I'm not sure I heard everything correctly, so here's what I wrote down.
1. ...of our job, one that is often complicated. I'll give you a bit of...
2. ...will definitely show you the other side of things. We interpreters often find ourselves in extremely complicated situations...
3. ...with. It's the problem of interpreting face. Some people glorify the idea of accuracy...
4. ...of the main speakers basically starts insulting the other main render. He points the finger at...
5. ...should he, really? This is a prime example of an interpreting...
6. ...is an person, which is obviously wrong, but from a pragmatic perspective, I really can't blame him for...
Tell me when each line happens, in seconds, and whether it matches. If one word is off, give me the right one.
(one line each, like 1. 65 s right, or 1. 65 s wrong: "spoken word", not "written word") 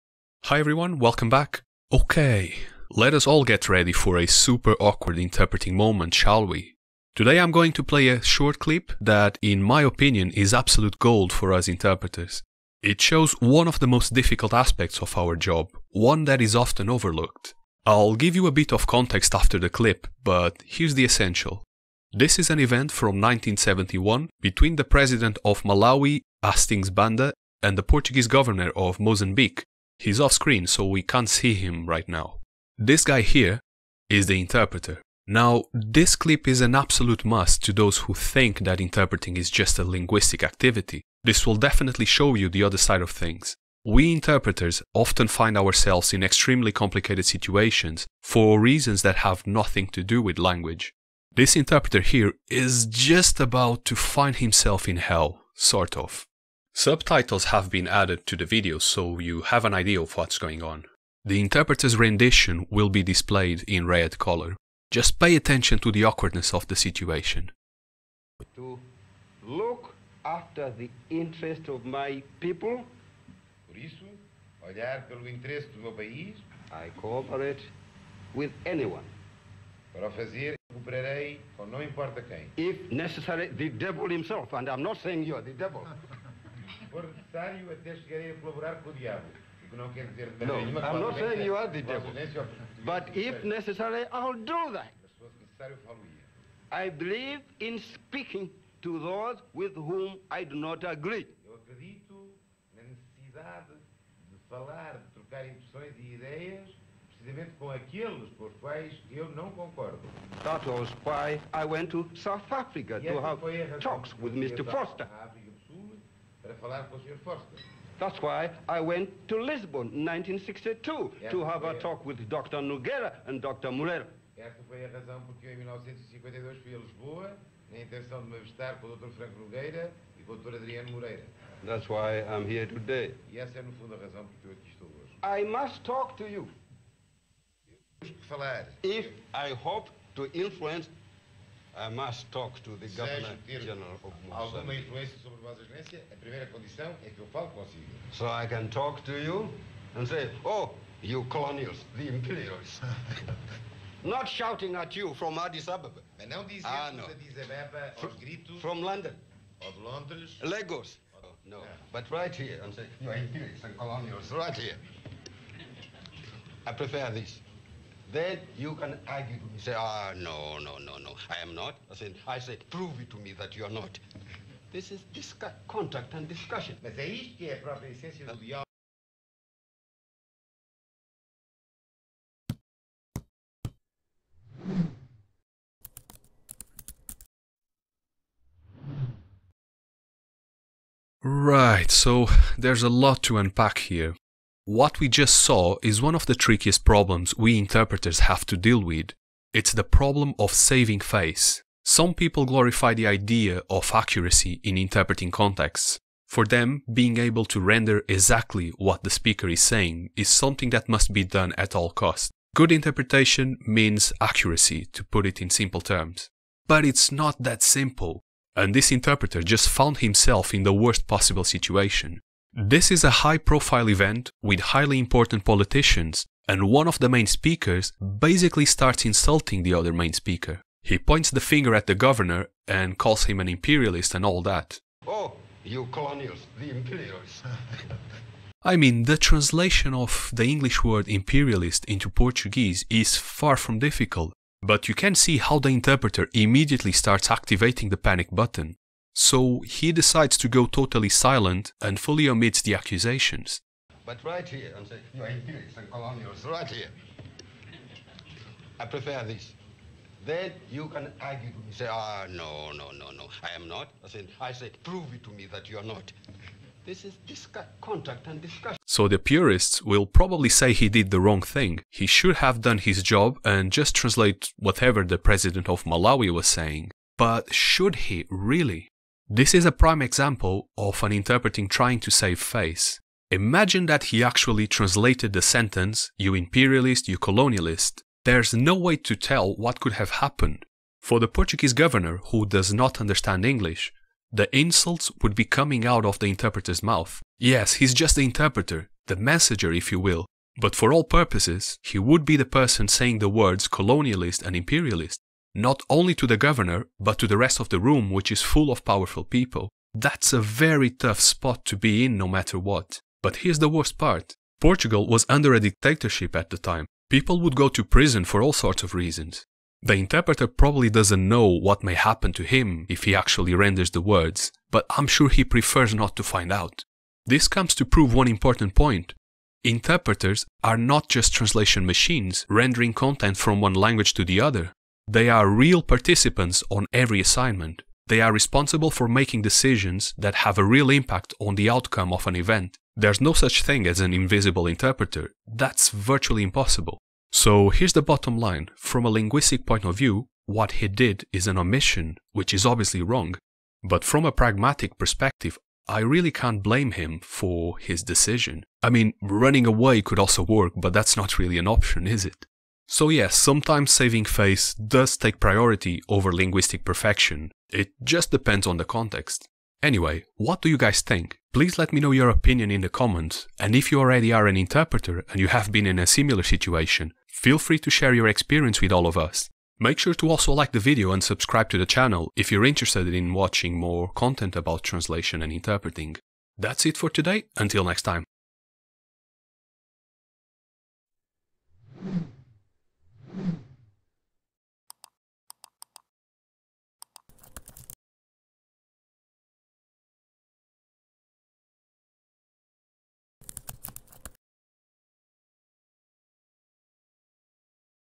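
1. 15 s wrong: "overlooked", not "complicated"
2. 41 s right
3. 198 s wrong: "saving", not "interpreting"
4. 226 s wrong: "speaker", not "render"
5. 277 s right
6. 351 s wrong: "omission", not "person".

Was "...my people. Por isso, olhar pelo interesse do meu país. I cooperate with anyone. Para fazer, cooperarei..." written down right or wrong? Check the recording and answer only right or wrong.
right.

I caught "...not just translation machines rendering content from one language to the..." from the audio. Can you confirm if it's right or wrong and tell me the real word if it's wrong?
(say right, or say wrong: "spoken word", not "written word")
right.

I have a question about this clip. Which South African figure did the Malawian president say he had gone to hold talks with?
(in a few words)
Mr. Vorster.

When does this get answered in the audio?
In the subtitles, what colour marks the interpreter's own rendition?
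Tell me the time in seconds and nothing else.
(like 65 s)
63 s.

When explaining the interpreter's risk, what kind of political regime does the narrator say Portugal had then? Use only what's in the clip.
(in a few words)
a dictatorship.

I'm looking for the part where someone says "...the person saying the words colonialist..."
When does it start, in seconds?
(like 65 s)
302 s.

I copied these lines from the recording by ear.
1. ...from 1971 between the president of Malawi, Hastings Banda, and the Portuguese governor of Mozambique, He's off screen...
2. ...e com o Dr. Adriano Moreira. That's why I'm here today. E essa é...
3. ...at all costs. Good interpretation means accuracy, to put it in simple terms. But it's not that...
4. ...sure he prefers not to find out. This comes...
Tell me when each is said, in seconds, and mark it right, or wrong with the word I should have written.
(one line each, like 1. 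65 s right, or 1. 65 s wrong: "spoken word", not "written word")
1. 22 s right
2. 130 s right
3. 211 s right
4. 325 s right.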